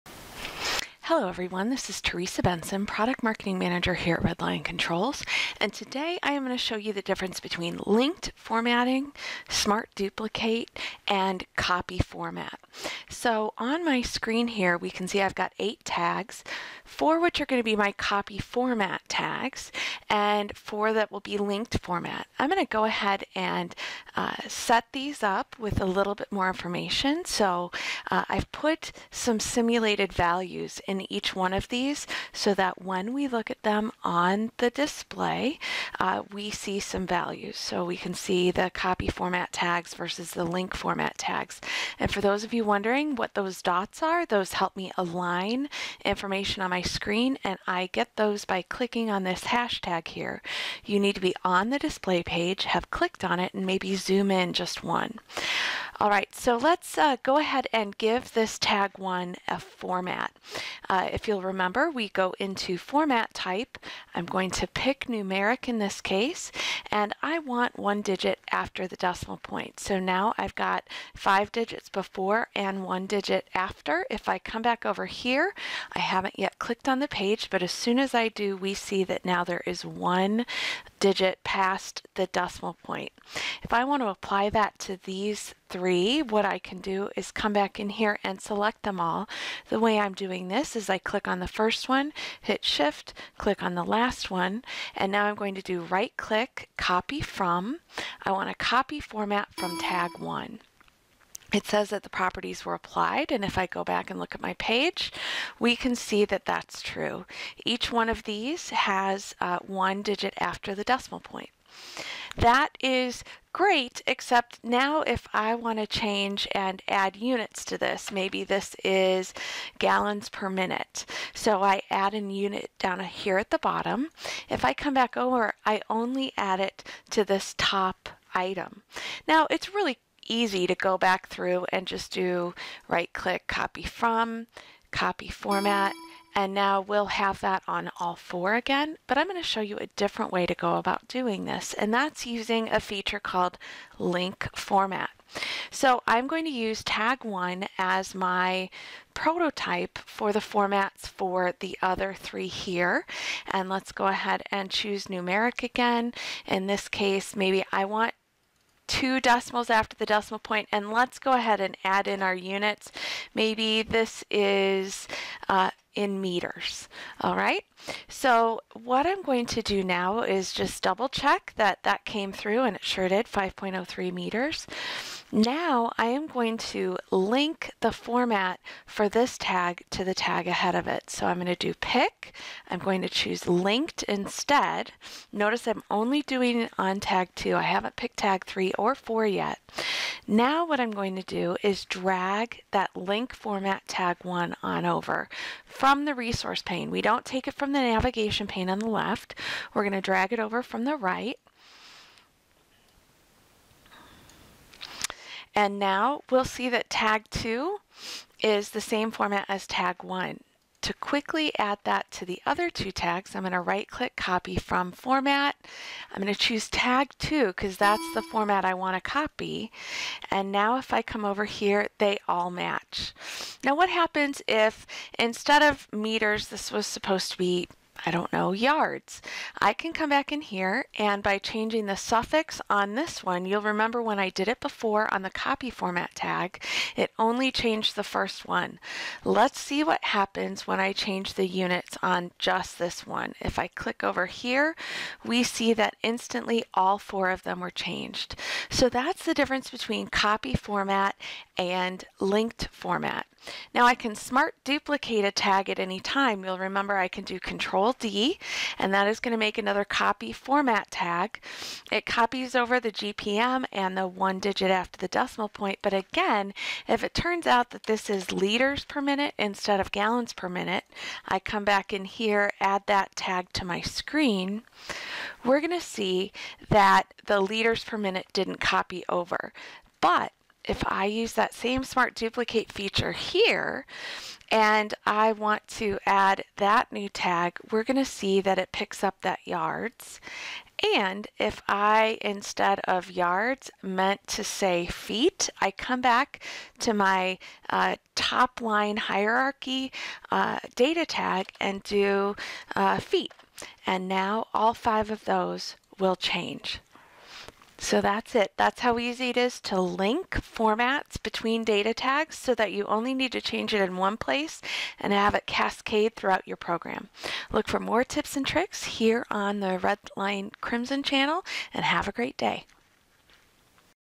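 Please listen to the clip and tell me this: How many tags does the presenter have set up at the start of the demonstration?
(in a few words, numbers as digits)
8.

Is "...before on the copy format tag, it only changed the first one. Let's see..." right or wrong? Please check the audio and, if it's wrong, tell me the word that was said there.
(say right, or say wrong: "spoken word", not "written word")
right.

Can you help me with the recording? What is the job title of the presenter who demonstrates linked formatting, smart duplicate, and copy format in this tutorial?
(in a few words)
Product Marketing Manager.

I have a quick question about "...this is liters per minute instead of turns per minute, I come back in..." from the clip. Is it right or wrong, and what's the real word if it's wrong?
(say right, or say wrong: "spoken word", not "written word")
wrong: "gallons", not "turns".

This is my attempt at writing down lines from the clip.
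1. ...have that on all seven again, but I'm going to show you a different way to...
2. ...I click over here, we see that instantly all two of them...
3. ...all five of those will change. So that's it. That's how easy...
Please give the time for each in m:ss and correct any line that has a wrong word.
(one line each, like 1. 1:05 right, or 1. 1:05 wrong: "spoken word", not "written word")
1. 2:17 wrong: "four", not "seven"
2. 4:03 wrong: "four", not "two"
3. 5:04 right.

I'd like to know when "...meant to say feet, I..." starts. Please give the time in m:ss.
4:53.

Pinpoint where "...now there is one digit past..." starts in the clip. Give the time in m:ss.
1:19.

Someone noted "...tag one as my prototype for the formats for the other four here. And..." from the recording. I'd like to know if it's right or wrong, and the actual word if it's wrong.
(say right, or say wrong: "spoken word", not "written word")
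wrong: "three", not "four".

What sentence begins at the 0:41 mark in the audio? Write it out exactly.
And for those of you wondering, what those dots are.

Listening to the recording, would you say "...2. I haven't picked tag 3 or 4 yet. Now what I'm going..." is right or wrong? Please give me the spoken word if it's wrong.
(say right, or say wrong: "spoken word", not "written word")
right.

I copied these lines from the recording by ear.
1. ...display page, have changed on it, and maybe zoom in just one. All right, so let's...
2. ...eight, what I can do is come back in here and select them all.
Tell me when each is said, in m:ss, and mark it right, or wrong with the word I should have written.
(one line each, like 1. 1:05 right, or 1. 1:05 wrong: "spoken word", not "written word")
1. 0:51 wrong: "clicked", not "changed"
2. 1:25 wrong: "three", not "eight".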